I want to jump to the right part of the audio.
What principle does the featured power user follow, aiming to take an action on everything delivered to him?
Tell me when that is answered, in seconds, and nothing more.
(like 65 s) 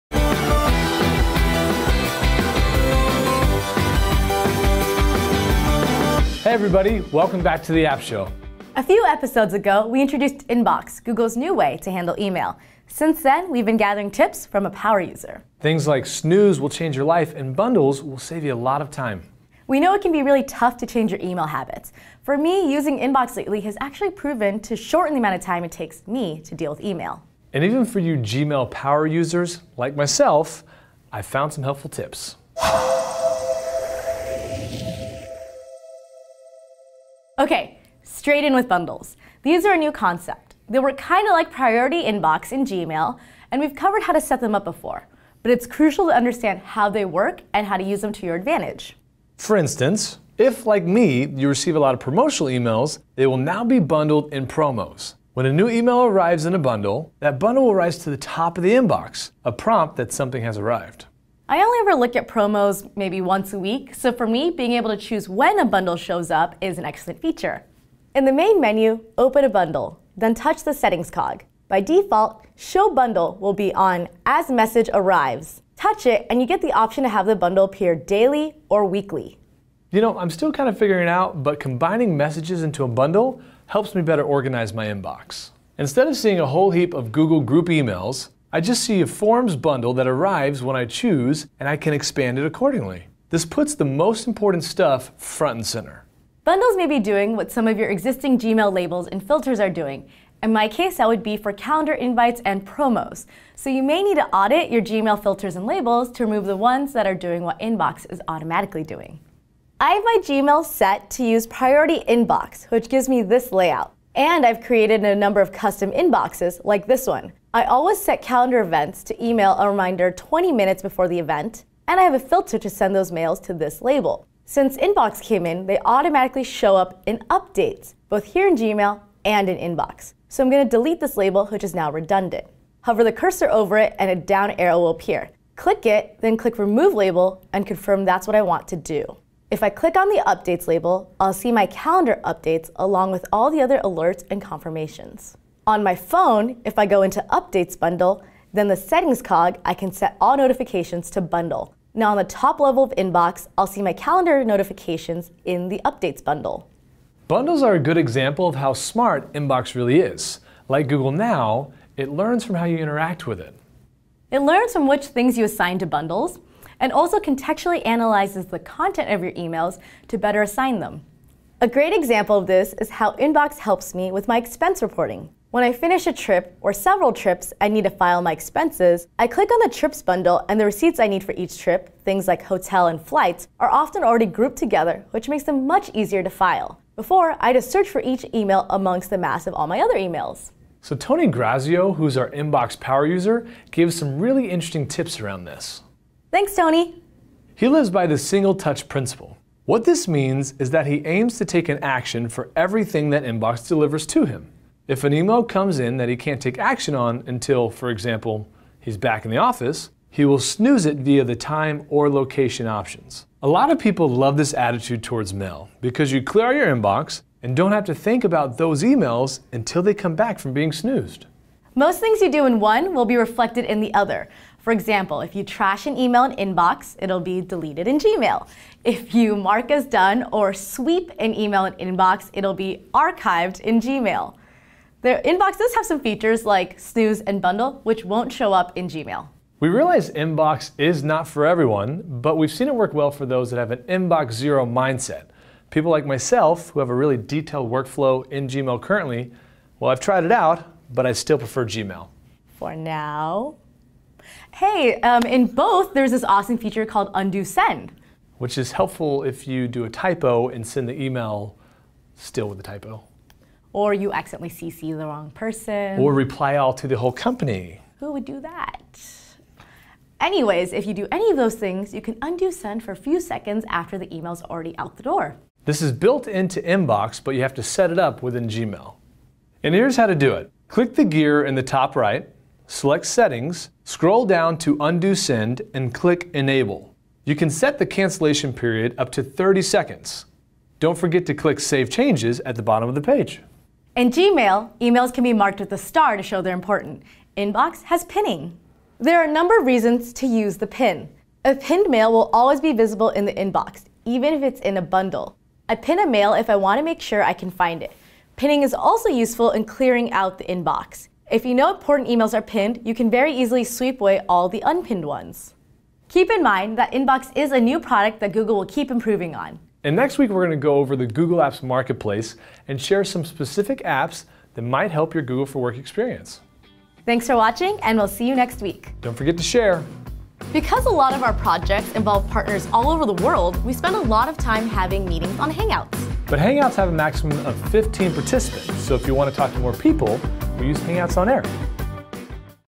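198 s.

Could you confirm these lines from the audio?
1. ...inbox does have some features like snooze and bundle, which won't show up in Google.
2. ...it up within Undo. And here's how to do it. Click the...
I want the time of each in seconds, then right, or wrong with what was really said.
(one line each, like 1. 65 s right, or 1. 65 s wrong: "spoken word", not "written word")
1. 235 s wrong: "Gmail", not "Google"
2. 277 s wrong: "Gmail", not "Undo".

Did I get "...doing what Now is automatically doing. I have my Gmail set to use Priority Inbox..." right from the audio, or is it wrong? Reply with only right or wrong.
wrong.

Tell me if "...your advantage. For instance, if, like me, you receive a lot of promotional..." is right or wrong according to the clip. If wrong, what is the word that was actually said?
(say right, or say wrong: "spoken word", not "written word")
right.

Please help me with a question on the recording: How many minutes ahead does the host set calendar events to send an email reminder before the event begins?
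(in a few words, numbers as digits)
20.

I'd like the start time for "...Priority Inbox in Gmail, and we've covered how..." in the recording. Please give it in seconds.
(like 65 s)
41 s.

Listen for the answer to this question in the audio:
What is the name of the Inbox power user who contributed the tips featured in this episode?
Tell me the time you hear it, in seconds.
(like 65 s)
190 s.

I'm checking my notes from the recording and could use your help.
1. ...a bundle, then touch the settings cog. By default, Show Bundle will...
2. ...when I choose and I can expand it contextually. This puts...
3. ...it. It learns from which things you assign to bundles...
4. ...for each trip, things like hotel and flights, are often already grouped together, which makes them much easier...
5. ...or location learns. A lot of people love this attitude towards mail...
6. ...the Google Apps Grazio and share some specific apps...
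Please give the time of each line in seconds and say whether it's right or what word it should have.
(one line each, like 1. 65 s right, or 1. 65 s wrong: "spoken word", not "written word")
1. 69 s right
2. 90 s wrong: "accordingly", not "contextually"
3. 163 s right
4. 181 s right
5. 211 s wrong: "options", not "learns"
6. 320 s wrong: "Marketplace", not "Grazio".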